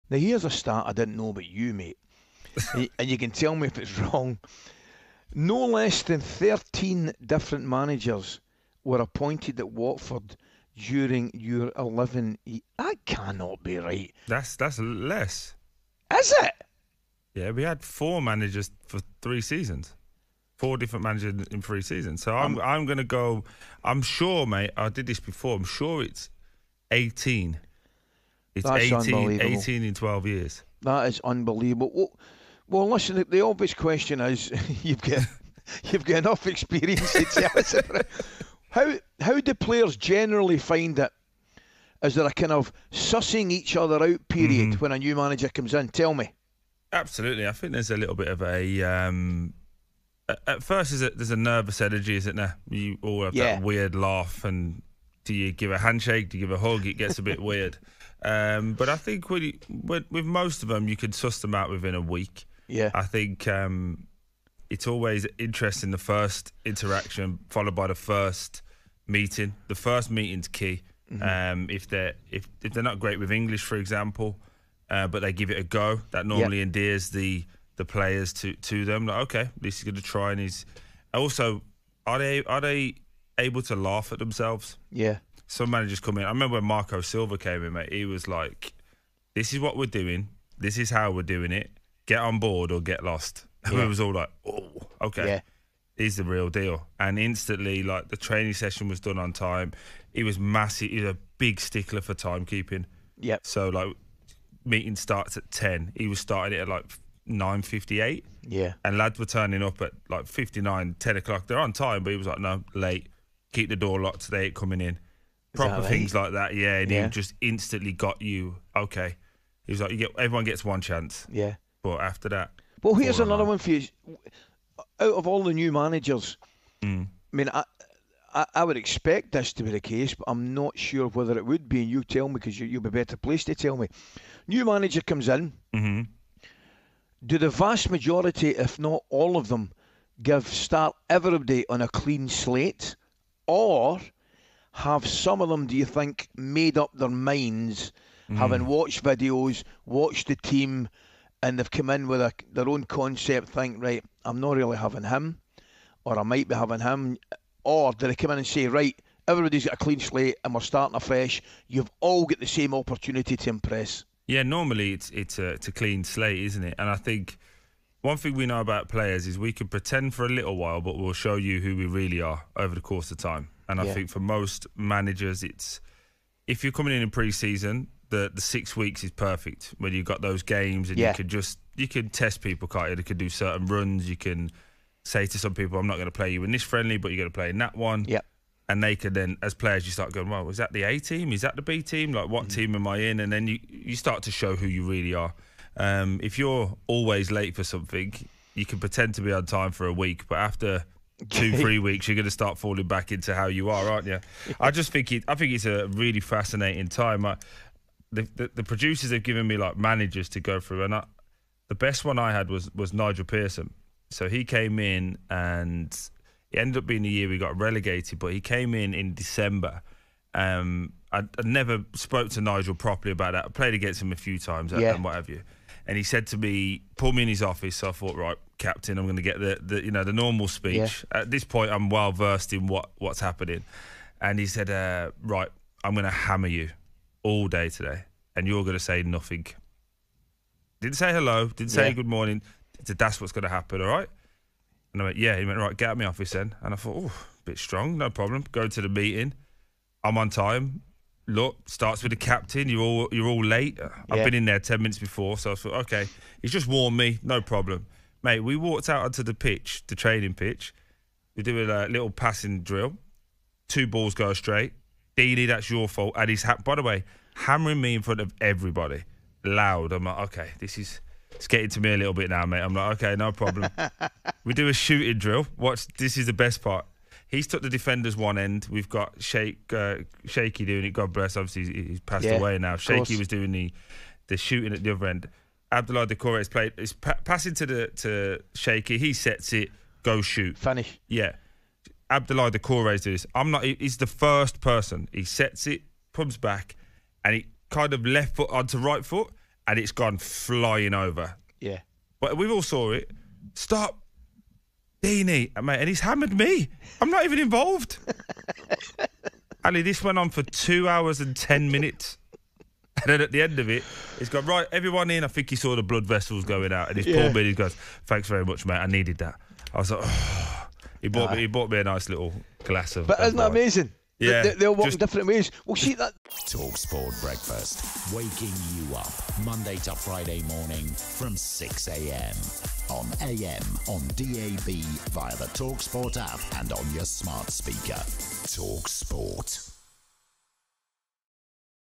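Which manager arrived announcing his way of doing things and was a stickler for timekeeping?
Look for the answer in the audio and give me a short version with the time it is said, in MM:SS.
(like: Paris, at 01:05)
Marco Silva, at 01:26.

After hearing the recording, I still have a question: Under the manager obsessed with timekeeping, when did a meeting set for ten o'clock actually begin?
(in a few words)
9:58.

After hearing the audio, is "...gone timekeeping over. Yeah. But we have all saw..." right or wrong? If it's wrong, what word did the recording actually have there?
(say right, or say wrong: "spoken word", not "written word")
wrong: "flying", not "timekeeping".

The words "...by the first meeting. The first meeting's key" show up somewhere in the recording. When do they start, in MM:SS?
01:07.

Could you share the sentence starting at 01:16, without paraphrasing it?
endears the the players to to them.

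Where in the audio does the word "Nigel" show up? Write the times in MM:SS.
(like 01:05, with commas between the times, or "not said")
03:32, 03:42.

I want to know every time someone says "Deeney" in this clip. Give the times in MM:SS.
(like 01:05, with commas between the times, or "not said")
04:25, 05:05.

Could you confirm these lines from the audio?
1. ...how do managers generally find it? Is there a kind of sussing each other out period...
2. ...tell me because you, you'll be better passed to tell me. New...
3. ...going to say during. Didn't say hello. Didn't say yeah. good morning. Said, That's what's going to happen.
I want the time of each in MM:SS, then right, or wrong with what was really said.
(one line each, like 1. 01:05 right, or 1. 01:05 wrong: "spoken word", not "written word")
1. 00:39 wrong: "players", not "managers"
2. 02:12 wrong: "placed", not "passed"
3. 03:58 wrong: "nothing", not "during".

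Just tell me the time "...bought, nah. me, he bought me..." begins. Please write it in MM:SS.
05:21.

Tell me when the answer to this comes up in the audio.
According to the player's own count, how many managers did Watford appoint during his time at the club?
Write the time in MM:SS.
00:28.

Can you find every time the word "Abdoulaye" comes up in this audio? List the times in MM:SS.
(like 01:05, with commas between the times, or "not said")
04:45, 04:52.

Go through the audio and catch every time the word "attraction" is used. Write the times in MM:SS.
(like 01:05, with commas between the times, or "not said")
not said.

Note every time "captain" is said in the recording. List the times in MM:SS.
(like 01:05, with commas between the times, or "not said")
03:48, 04:12.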